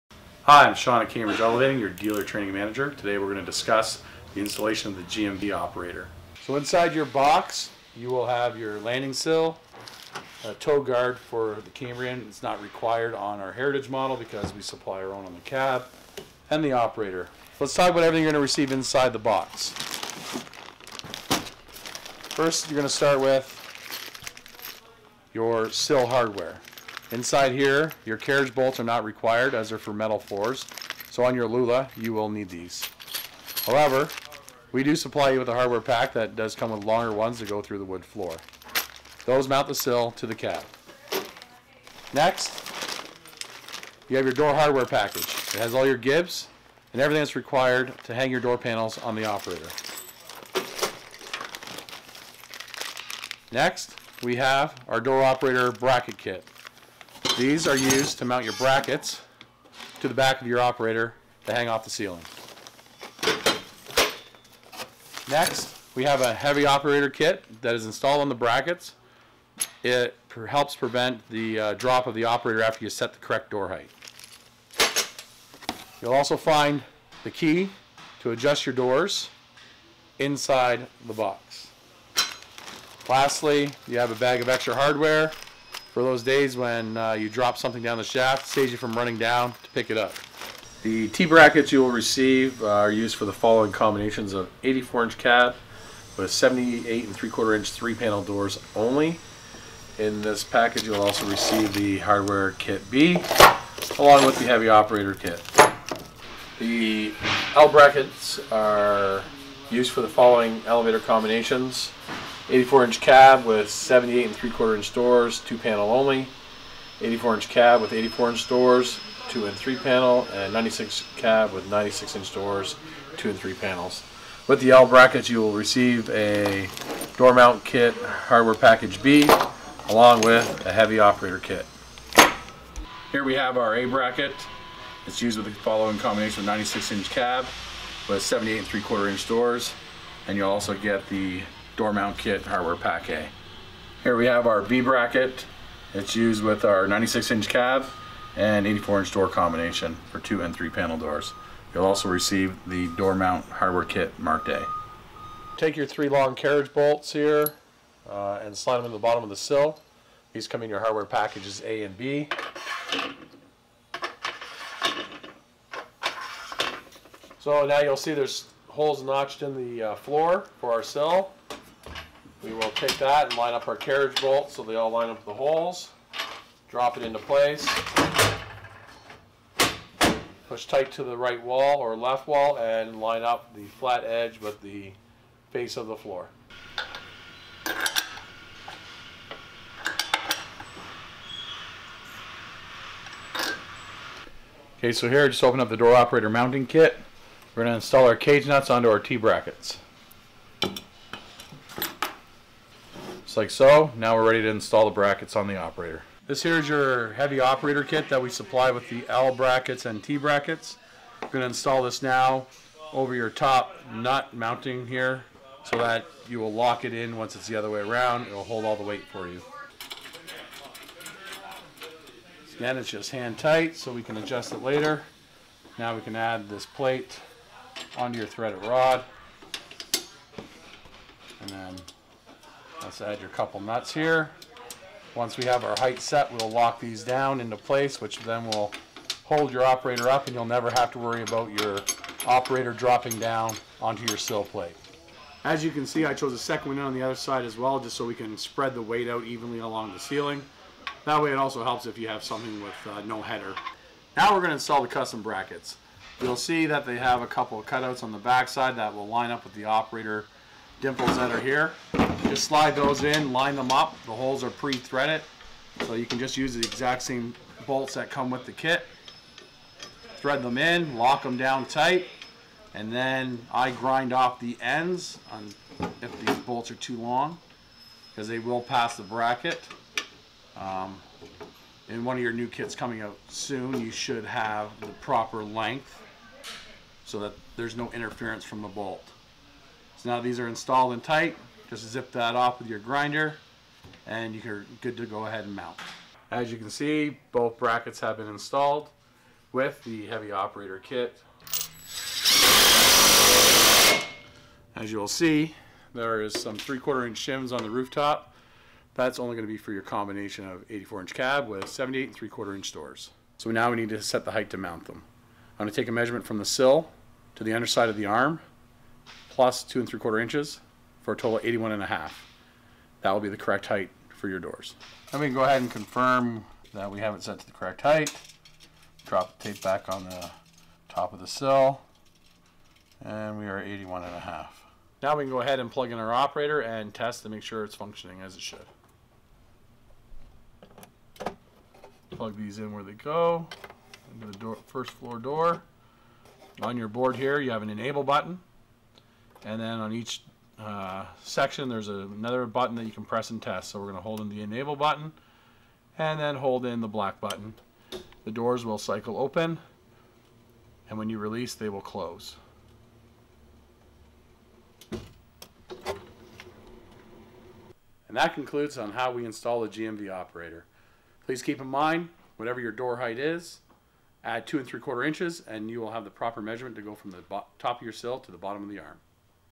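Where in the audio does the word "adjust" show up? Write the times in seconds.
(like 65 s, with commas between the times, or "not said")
78 s, 224 s.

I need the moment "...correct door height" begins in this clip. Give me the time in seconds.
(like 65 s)
73 s.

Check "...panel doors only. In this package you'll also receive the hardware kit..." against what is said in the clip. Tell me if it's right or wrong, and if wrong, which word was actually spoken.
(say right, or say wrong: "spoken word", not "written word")
right.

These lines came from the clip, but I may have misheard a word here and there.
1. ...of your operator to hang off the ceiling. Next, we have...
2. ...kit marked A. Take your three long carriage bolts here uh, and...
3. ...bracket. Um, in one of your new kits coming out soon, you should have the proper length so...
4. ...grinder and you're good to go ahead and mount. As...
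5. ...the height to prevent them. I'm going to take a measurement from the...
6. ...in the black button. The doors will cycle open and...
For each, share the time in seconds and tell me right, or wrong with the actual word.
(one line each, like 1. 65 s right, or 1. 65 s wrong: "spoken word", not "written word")
1. 60 s right
2. 153 s right
3. 279 s right
4. 292 s right
5. 314 s wrong: "mount", not "prevent"
6. 356 s right.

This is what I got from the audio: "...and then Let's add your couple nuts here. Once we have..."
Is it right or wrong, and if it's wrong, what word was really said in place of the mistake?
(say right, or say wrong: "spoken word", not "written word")
right.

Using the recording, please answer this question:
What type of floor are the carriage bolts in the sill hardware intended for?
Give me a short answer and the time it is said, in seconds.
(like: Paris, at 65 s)
Metal floors, at 29 s.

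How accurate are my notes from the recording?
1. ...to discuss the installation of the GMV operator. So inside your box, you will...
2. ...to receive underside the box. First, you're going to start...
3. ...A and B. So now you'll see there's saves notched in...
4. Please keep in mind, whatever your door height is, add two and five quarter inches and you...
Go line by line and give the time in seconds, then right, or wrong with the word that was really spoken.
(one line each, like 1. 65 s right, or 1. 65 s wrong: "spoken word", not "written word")
1. 3 s right
2. 18 s wrong: "inside", not "underside"
3. 161 s wrong: "holes", not "saves"
4. 371 s wrong: "three", not "five".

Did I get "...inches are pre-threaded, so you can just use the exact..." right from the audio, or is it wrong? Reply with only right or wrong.
wrong.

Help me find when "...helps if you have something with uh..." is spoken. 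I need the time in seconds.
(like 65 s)
251 s.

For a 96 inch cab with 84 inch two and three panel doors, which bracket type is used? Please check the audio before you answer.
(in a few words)
B bracket.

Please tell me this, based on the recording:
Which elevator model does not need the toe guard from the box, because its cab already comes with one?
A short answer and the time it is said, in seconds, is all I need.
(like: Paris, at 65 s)
Heritage, at 13 s.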